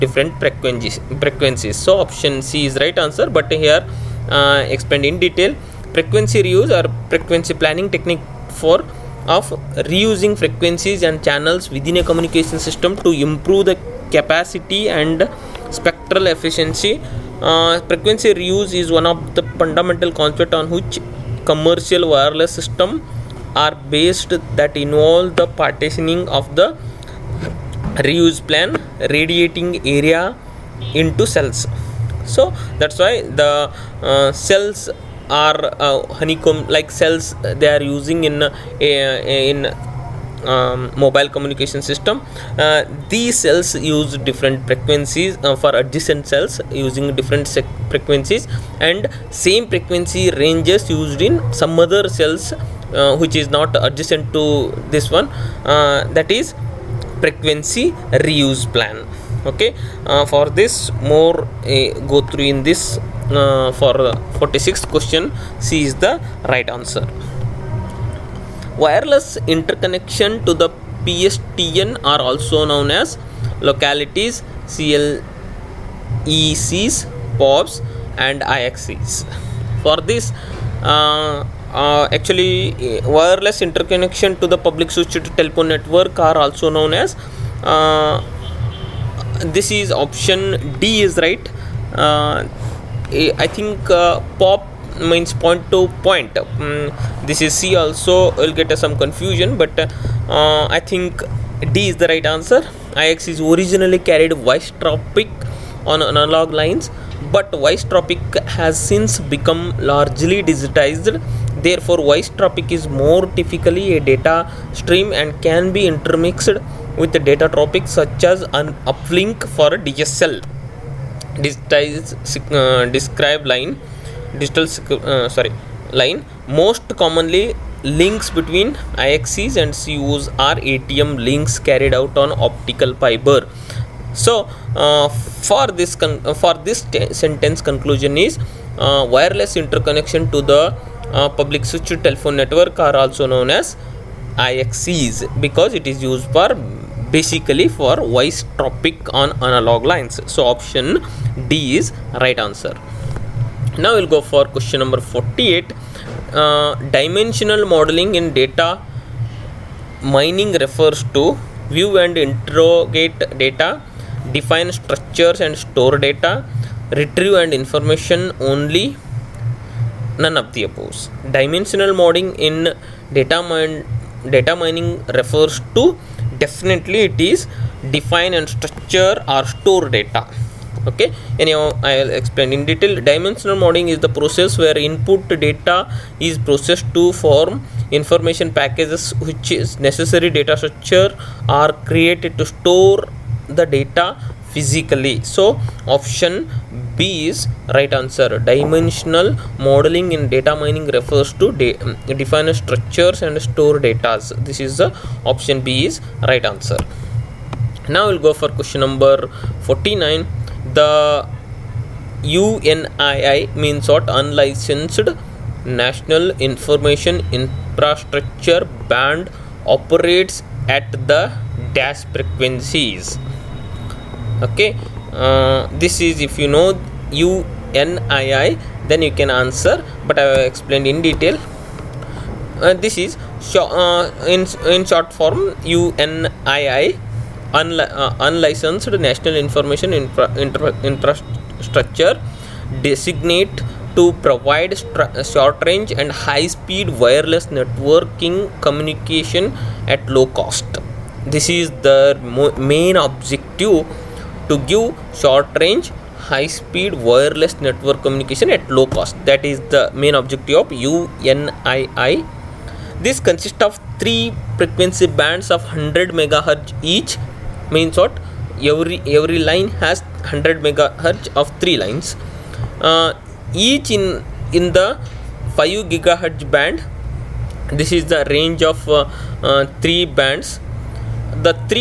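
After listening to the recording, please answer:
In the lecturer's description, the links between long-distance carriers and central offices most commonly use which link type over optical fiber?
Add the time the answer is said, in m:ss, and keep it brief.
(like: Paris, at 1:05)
ATM, at 2:10.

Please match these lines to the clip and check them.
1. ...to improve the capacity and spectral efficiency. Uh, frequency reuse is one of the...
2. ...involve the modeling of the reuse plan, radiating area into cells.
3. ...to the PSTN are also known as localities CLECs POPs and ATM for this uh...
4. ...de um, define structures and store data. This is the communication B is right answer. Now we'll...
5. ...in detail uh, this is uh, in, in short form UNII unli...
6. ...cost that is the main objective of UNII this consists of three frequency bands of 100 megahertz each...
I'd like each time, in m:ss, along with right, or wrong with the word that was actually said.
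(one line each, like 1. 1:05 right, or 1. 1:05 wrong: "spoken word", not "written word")
1. 0:12 right
2. 0:24 wrong: "partitioning", not "modeling"
3. 1:10 wrong: "IXCs", not "ATM"
4. 3:21 wrong: "option", not "communication"
5. 3:50 right
6. 4:18 right.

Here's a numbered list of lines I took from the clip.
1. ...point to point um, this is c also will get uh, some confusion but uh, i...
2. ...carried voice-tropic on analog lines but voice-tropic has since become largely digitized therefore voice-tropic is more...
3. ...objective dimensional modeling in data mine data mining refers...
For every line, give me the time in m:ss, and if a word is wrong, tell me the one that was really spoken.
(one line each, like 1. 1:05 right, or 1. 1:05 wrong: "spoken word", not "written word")
1. 1:35 right
2. 1:44 right
3. 2:50 wrong: "above", not "objective".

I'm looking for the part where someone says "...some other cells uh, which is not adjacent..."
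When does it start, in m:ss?
0:51.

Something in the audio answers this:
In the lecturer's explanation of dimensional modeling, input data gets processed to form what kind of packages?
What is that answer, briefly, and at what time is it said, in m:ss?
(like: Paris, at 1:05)
information packages, at 3:07.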